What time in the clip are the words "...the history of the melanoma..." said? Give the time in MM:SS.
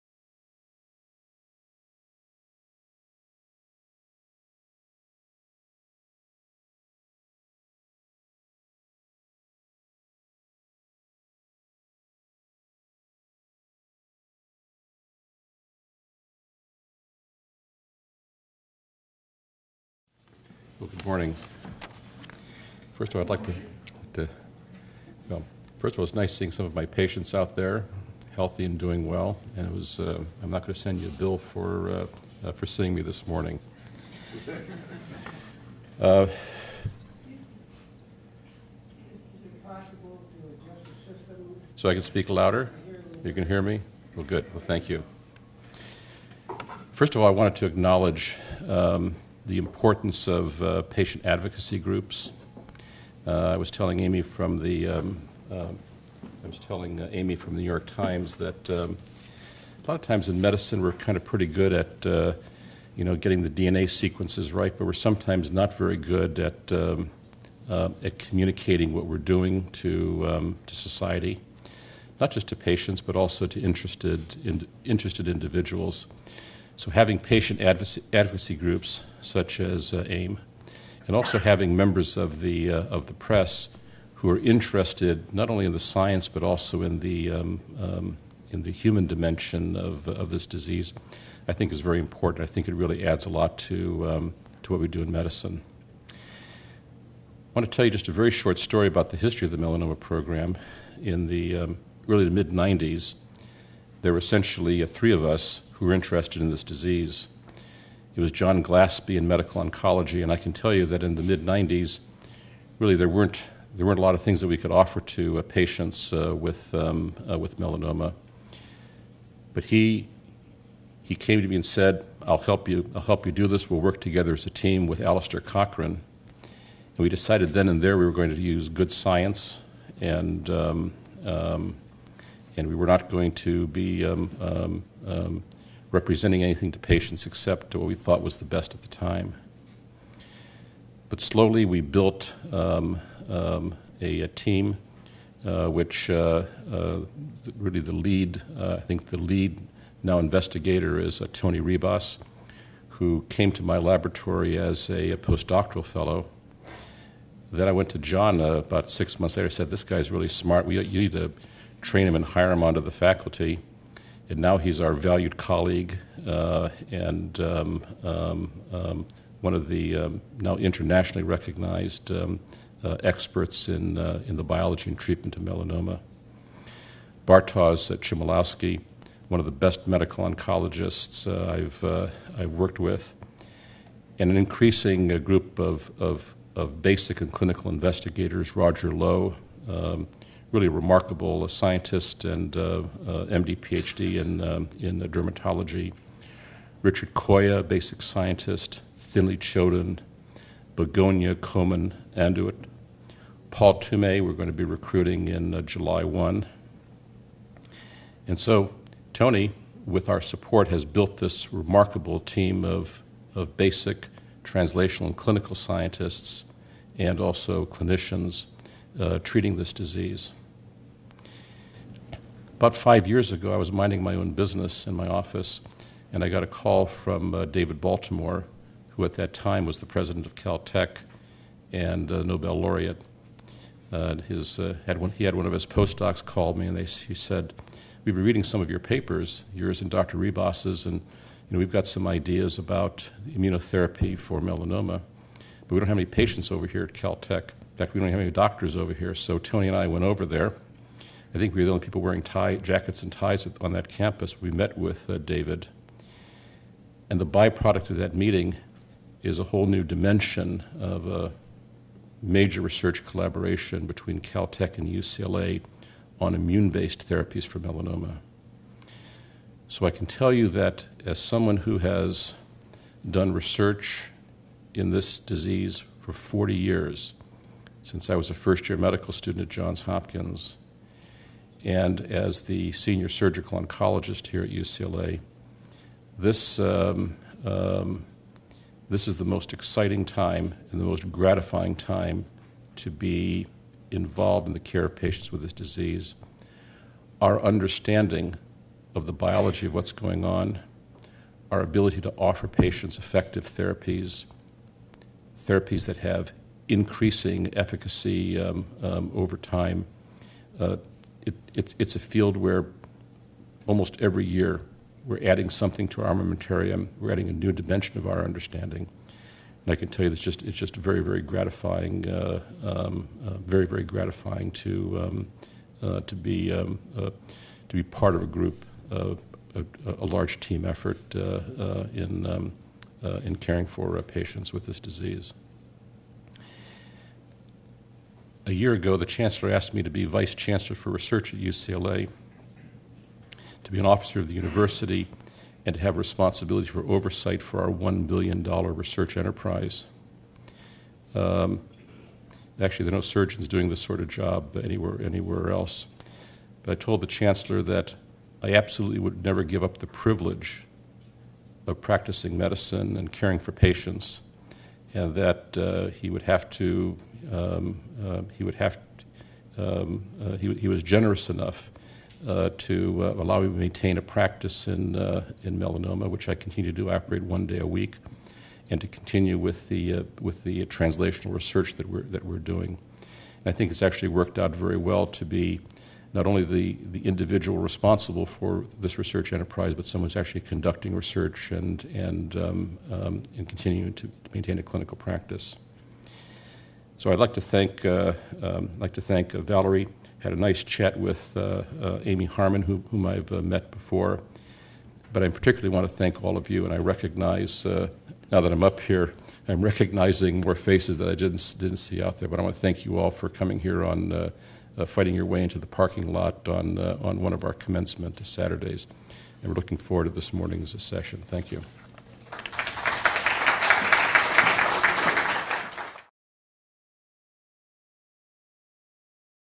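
01:39.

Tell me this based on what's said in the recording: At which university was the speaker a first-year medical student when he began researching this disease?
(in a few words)
Johns Hopkins.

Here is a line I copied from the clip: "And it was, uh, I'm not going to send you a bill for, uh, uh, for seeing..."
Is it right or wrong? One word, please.
right.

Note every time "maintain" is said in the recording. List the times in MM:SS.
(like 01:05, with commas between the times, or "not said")
06:13, 06:34.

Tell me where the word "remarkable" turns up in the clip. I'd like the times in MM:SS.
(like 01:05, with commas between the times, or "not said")
03:10, 03:31.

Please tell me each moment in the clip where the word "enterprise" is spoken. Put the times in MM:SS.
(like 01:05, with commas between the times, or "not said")
05:49, 06:29.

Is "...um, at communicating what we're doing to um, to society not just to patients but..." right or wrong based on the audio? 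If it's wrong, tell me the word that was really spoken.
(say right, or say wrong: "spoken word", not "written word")
right.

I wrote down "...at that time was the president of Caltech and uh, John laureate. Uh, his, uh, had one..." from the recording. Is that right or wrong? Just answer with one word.
wrong.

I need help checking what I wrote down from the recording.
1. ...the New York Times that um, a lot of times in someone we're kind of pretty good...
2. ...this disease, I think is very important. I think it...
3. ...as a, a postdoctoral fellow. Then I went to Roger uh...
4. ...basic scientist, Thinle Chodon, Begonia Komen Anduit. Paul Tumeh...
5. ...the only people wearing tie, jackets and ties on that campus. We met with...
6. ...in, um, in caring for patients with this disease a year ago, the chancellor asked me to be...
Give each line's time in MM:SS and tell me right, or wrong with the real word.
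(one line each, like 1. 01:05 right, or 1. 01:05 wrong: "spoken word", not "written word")
1. 00:57 wrong: "medicine", not "someone"
2. 01:30 right
3. 02:34 wrong: "John", not "Roger"
4. 03:17 right
5. 04:11 right
6. 05:31 right.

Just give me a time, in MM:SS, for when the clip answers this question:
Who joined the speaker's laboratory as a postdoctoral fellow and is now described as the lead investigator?
02:31.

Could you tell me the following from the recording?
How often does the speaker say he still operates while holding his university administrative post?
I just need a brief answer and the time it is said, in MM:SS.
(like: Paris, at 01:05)
one day a week, at 06:17.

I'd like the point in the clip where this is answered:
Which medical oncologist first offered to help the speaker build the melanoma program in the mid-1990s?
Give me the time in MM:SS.
01:48.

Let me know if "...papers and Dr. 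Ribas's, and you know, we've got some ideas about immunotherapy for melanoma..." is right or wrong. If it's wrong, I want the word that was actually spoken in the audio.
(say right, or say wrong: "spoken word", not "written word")
wrong: "yours", not "papers".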